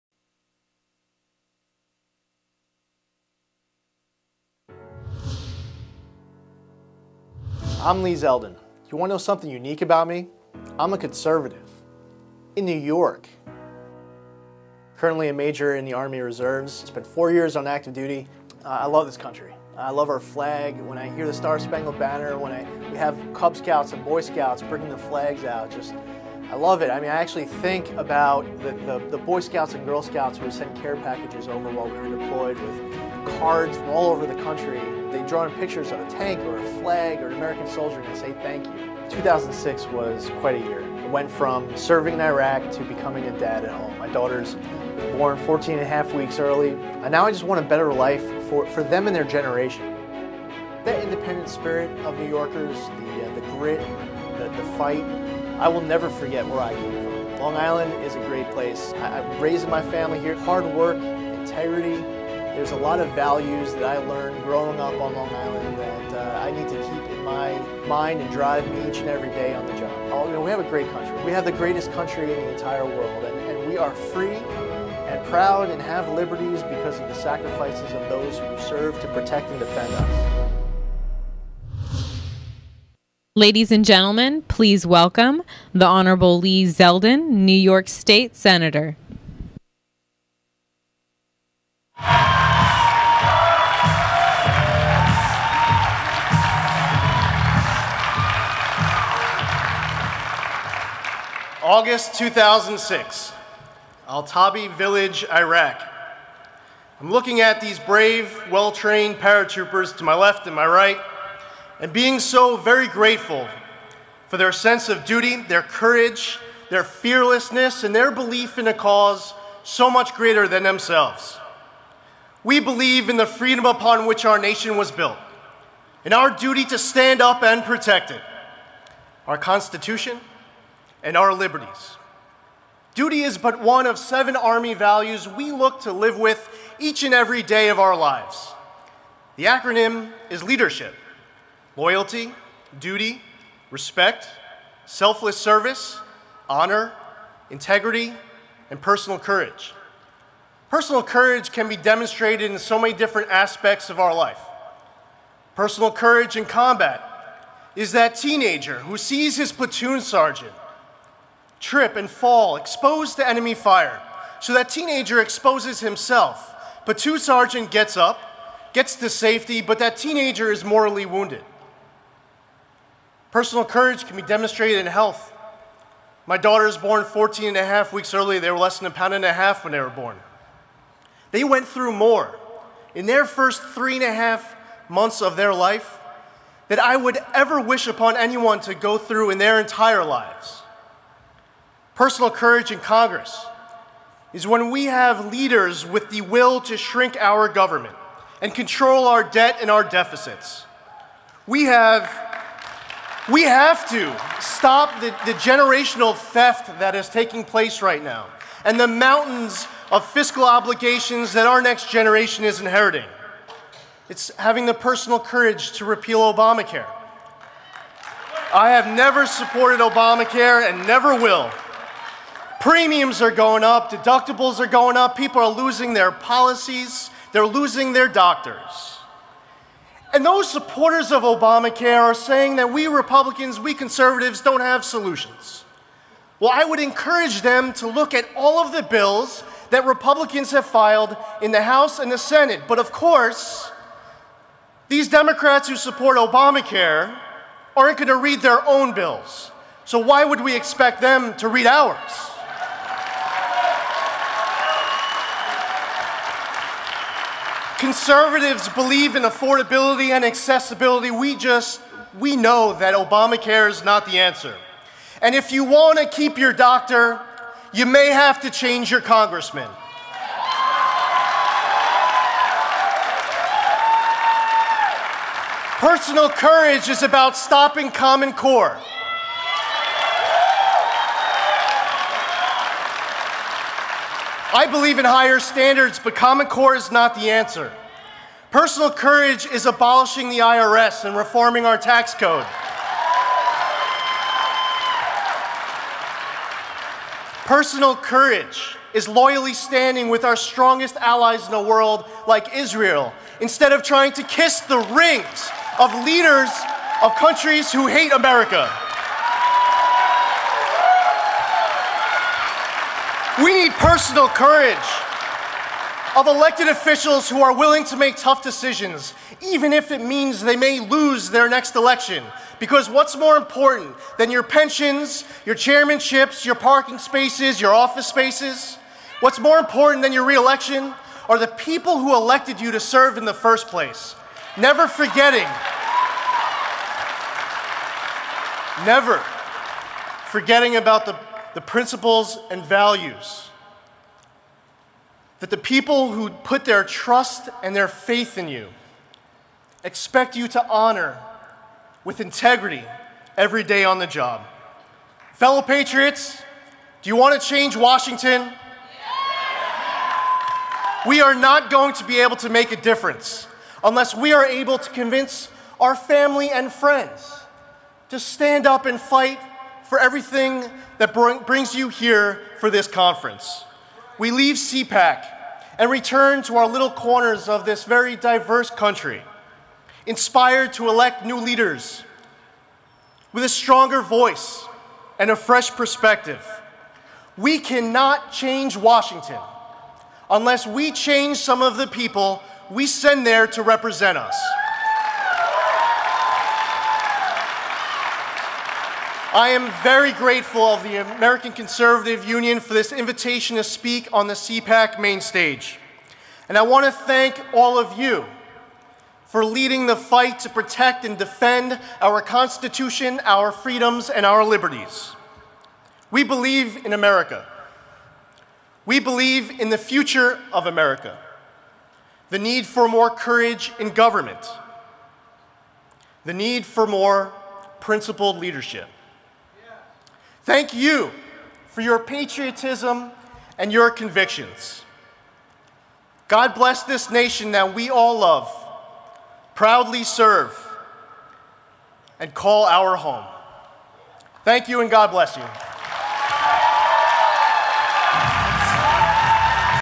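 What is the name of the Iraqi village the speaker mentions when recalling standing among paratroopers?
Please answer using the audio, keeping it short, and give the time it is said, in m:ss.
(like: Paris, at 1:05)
Al Tabi Village, at 1:44.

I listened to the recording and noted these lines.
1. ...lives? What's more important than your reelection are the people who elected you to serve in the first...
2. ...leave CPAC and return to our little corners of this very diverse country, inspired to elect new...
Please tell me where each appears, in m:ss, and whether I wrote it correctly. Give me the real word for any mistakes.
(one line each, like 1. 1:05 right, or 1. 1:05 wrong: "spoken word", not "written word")
1. 5:28 wrong: "spaces", not "lives"
2. 6:14 right.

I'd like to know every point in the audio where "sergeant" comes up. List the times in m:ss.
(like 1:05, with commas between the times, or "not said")
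2:40, 2:47.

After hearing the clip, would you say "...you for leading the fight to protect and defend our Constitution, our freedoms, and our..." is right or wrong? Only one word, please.
right.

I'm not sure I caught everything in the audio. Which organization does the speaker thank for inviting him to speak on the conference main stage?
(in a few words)
American Conservative Union.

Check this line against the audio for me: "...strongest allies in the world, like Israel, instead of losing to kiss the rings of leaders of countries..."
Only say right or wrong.
wrong.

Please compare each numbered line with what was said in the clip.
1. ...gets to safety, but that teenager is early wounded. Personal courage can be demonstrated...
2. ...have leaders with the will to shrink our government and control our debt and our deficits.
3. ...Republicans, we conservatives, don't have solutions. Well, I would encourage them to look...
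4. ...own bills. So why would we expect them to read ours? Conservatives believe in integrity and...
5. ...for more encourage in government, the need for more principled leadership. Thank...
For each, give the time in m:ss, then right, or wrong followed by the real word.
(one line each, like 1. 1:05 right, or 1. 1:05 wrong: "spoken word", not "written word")
1. 2:48 wrong: "mortally", not "early"
2. 3:14 right
3. 3:52 right
4. 4:08 wrong: "affordability", not "integrity"
5. 7:02 wrong: "courage", not "encourage".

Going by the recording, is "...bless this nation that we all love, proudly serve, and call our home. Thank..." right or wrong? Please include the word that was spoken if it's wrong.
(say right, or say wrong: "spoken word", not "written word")
right.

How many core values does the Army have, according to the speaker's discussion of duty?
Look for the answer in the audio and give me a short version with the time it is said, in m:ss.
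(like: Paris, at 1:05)
7, at 2:13.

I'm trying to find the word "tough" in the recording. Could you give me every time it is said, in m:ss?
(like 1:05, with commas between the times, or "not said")
5:18.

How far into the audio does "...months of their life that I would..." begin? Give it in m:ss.
3:04.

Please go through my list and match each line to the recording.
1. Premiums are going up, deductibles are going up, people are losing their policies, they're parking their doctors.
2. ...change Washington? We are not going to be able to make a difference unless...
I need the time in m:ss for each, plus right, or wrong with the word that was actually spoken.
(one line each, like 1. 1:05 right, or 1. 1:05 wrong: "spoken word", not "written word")
1. 3:42 wrong: "losing", not "parking"
2. 5:57 right.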